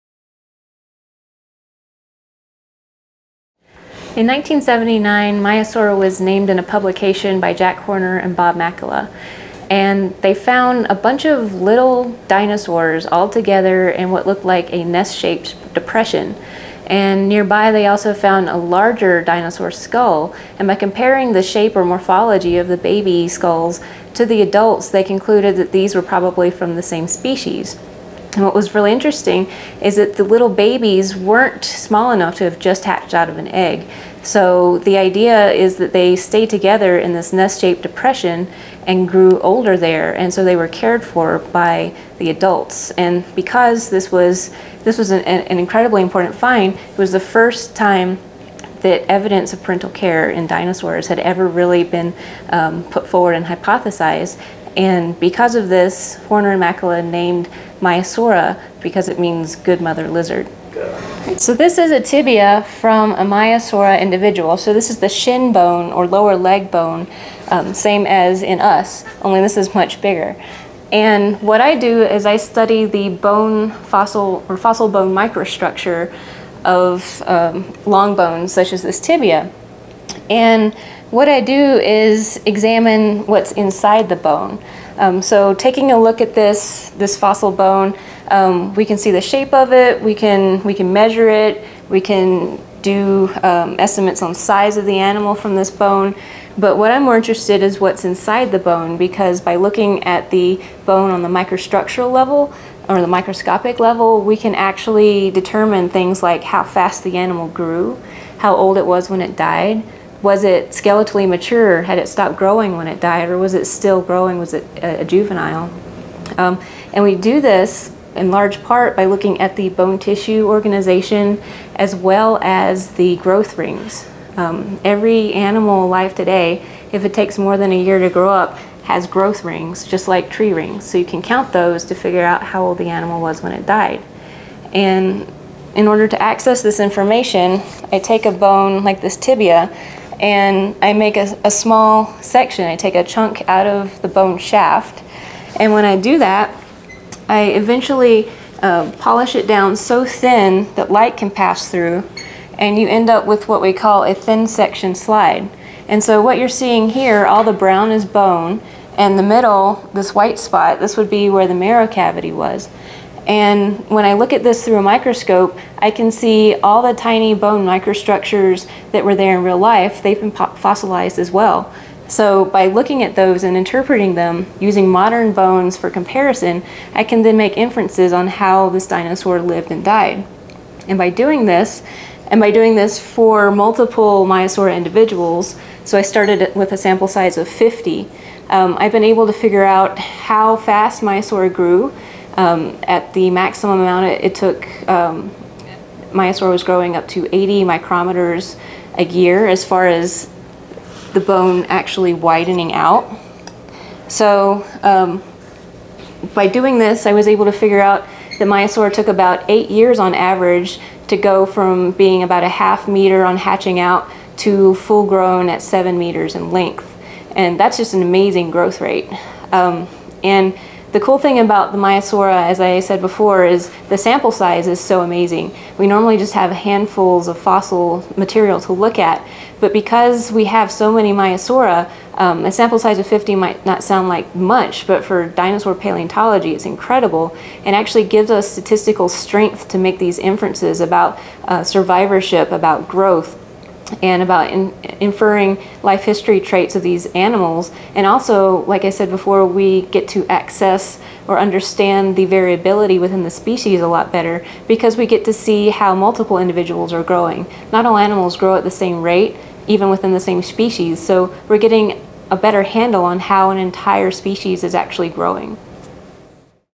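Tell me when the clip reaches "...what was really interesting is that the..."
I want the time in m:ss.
0:28.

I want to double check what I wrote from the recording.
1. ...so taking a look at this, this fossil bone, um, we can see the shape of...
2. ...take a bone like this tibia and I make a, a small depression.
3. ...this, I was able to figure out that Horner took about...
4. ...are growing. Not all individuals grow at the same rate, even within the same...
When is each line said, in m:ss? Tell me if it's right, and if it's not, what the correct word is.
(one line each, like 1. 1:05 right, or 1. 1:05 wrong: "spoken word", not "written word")
1. 1:25 right
2. 2:17 wrong: "section", not "depression"
3. 3:26 wrong: "Maiasaura", not "Horner"
4. 4:16 wrong: "animals", not "individuals".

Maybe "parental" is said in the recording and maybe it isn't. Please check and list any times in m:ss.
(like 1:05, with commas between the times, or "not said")
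0:49.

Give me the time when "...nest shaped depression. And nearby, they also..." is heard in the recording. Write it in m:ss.
0:14.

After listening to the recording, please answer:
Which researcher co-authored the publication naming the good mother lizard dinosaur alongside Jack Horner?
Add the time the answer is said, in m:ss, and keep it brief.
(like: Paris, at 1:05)
Bob Makela, at 0:08.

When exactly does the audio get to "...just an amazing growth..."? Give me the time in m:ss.
3:37.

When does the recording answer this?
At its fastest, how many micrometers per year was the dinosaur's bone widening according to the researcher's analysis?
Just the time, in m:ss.
3:17.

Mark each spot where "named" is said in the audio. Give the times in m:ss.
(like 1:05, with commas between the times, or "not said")
0:06, 0:57.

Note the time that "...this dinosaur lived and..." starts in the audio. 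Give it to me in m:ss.
2:58.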